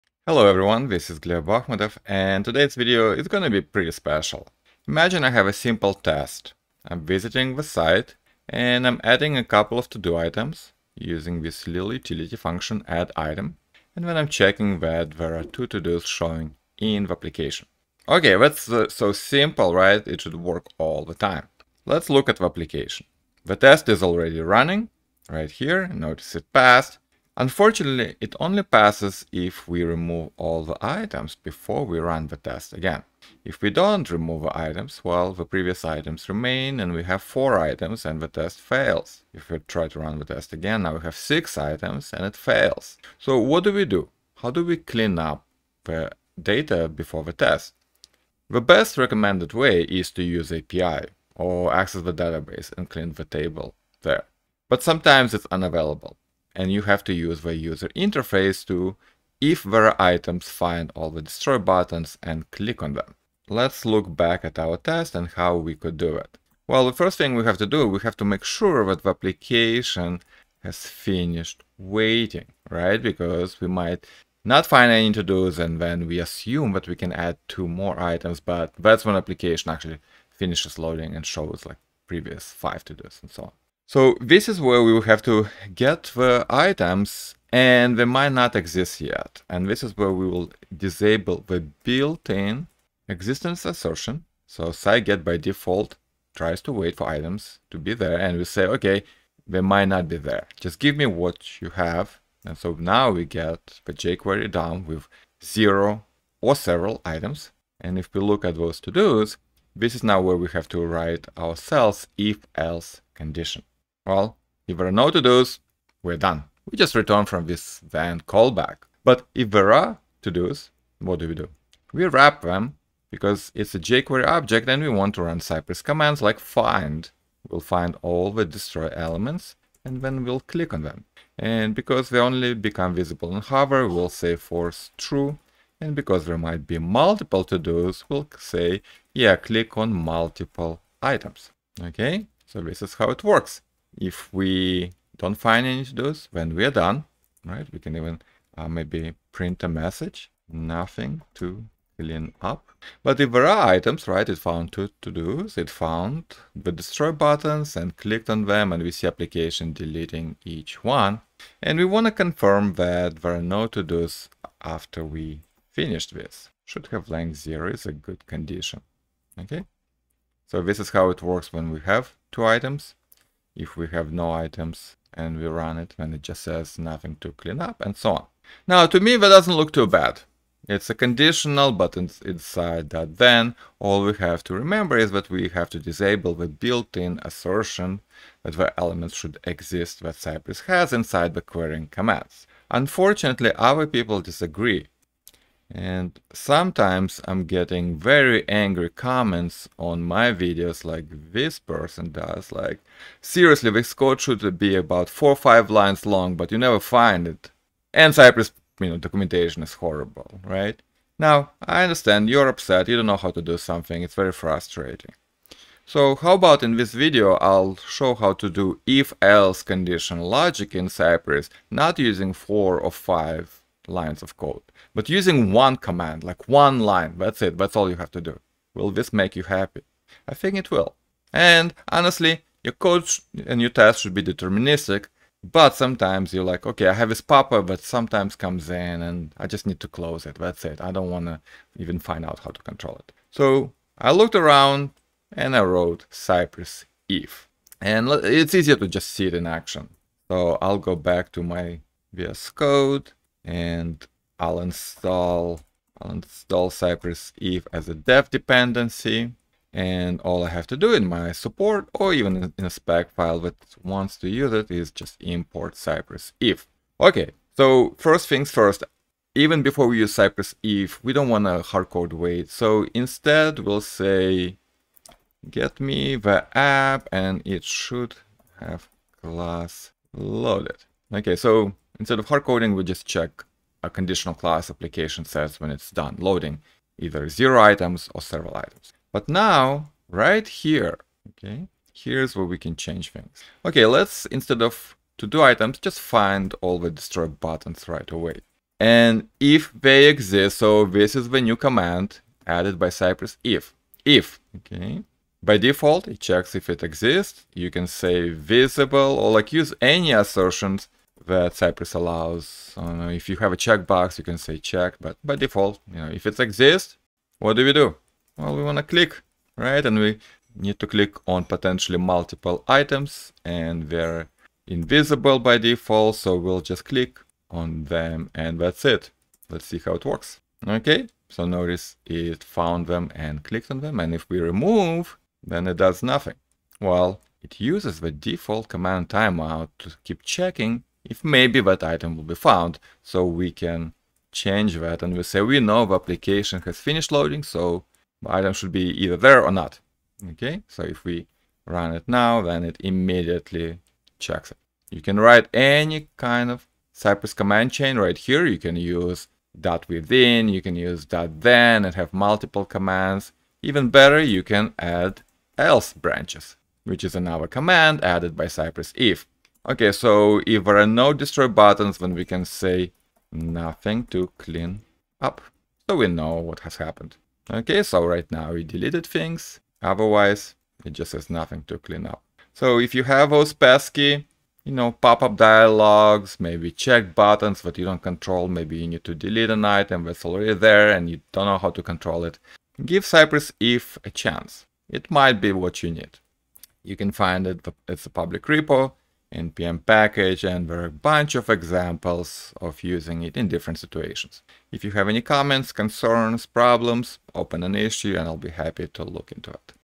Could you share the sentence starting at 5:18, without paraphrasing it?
Well, we want to click, right?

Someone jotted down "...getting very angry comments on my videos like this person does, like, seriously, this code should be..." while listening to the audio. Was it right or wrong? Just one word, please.
right.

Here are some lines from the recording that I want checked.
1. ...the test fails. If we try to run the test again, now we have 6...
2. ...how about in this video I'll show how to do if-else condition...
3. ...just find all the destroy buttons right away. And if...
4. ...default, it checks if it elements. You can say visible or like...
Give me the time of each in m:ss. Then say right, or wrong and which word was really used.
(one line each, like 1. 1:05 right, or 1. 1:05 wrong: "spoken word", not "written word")
1. 0:38 right
2. 3:36 right
3. 4:55 right
4. 5:05 wrong: "exists", not "elements".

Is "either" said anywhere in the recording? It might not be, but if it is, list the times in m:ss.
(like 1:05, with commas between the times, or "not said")
4:46, 5:49.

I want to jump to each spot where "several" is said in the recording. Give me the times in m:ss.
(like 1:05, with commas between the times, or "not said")
1:46, 4:48.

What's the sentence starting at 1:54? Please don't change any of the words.
Well, if there are no to-dos, we're done.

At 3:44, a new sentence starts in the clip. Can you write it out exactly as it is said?
But using one command, like one line, that's it, that's all you have to do.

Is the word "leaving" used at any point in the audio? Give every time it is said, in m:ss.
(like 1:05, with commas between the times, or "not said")
not said.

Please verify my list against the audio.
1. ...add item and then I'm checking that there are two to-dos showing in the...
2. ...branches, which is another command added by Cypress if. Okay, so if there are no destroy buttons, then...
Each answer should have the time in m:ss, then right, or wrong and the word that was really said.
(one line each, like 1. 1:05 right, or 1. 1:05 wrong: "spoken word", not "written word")
1. 0:12 right
2. 6:05 right.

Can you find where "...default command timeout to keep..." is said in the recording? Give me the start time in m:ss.
5:38.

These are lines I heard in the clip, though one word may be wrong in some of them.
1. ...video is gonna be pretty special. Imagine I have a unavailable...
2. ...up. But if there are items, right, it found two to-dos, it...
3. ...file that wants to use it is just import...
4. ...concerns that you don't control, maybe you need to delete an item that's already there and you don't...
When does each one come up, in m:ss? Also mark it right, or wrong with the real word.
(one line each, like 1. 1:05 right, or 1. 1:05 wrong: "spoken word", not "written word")
1. 0:02 wrong: "simple", not "unavailable"
2. 2:32 right
3. 4:23 right
4. 6:27 wrong: "buttons", not "concerns".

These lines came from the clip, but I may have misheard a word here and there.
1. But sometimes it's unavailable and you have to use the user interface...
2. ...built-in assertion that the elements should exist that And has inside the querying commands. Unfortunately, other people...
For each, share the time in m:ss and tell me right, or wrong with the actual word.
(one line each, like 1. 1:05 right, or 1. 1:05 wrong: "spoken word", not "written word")
1. 0:54 right
2. 3:06 wrong: "Cypress", not "And".